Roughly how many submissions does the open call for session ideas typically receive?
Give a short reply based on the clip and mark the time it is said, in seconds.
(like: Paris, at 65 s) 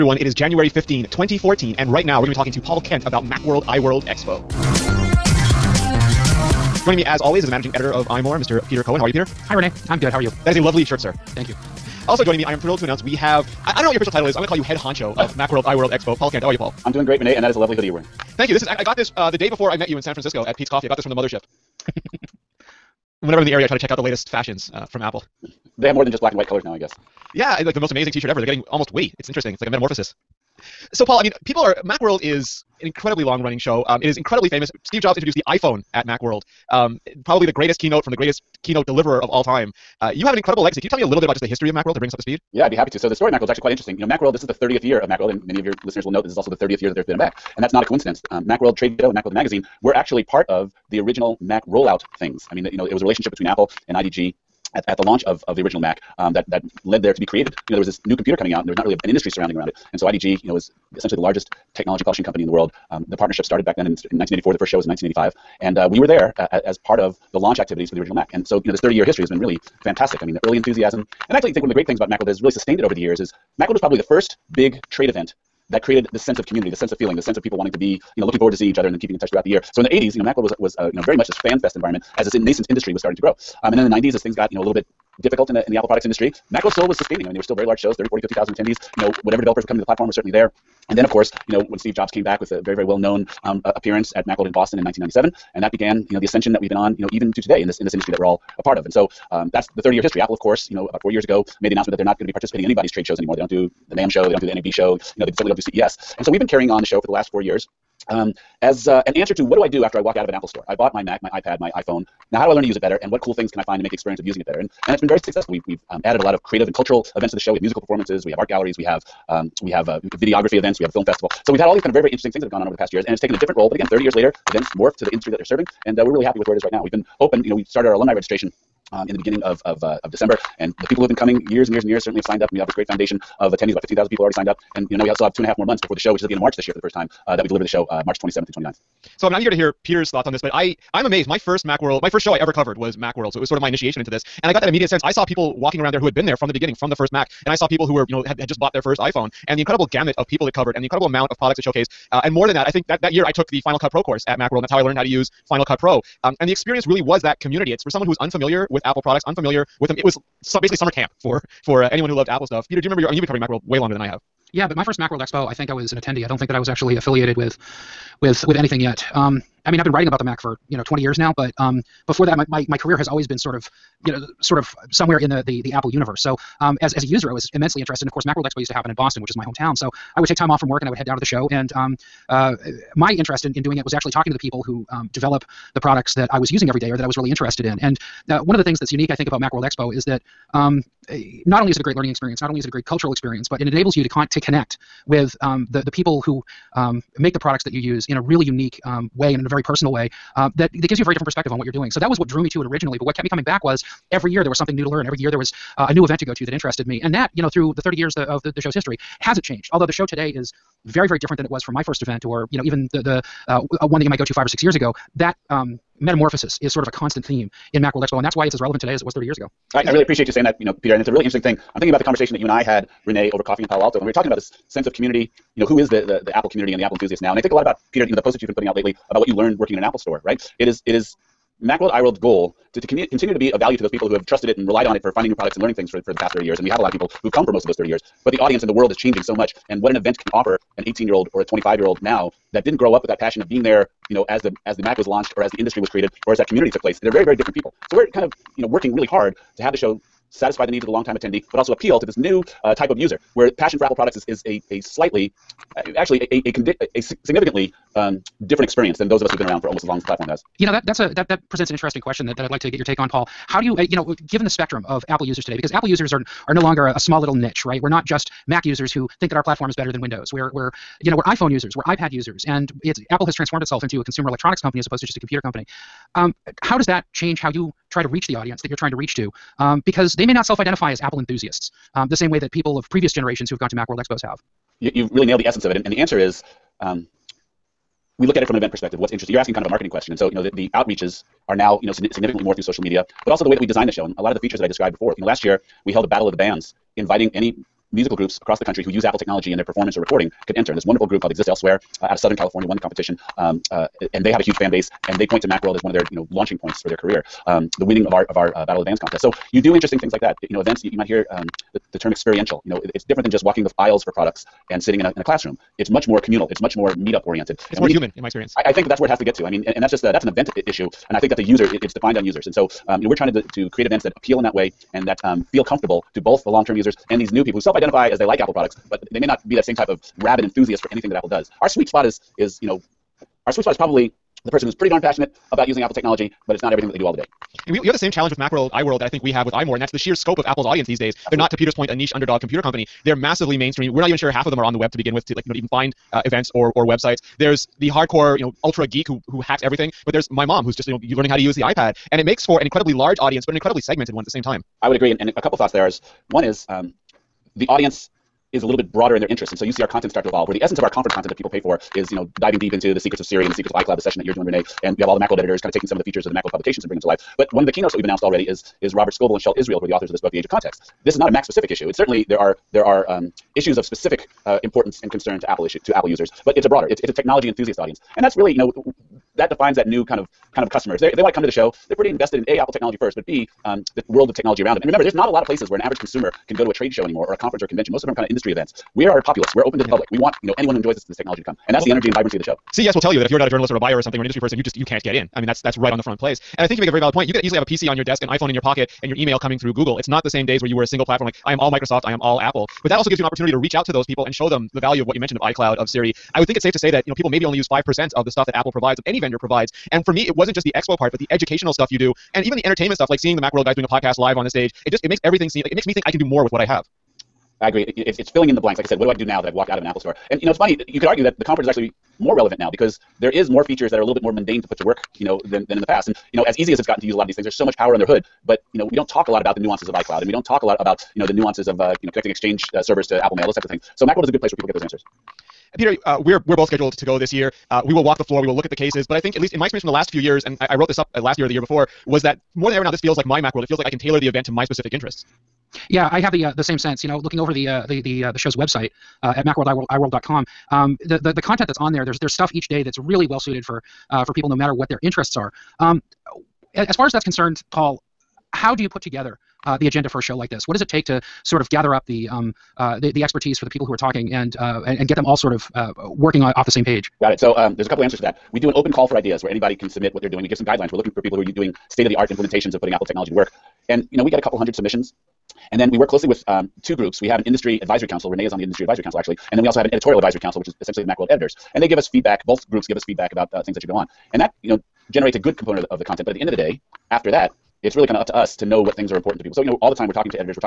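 a couple hundred, at 474 s.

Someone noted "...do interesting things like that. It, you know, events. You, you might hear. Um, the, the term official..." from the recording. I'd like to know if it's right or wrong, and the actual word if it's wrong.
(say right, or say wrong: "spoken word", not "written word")
wrong: "experiential", not "official".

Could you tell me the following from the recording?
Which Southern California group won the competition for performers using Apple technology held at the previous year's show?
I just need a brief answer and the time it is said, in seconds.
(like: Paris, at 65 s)
Exist Elsewhere, at 301 s.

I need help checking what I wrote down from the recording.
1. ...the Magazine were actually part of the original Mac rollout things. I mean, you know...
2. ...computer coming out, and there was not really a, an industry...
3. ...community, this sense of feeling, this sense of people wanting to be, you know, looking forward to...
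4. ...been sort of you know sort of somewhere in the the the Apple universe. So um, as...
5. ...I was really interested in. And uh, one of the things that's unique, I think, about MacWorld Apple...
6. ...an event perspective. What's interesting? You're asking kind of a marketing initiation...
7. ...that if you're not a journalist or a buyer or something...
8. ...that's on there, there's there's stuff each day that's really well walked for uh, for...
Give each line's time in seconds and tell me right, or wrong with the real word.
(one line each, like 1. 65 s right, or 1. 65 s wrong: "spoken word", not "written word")
1. 49 s right
2. 58 s right
3. 76 s right
4. 173 s right
5. 187 s wrong: "Expo", not "Apple"
6. 288 s wrong: "question", not "initiation"
7. 393 s right
8. 451 s wrong: "suited", not "walked".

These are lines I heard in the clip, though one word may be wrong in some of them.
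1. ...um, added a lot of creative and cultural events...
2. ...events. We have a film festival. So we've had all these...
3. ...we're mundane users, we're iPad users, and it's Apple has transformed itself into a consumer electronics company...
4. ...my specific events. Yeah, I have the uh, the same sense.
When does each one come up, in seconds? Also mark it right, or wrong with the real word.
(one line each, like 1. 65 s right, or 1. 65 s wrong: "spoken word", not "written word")
1. 115 s right
2. 120 s right
3. 271 s wrong: "iPhone", not "mundane"
4. 444 s wrong: "interests", not "events".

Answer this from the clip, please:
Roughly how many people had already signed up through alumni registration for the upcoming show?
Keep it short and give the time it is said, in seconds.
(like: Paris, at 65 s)
15,000, at 133 s.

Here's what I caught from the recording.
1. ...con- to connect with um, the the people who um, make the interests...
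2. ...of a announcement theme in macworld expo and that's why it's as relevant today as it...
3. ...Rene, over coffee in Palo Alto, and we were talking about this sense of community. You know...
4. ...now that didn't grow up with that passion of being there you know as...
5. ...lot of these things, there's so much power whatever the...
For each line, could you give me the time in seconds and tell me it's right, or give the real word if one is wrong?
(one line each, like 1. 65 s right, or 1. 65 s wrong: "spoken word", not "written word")
1. 194 s wrong: "products", not "interests"
2. 216 s wrong: "constant", not "announcement"
3. 223 s right
4. 242 s right
5. 427 s wrong: "under", not "whatever".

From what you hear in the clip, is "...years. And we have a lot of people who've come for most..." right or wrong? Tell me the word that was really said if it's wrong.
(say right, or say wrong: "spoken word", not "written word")
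right.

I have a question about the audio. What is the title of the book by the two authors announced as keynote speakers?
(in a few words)
The Age of Context.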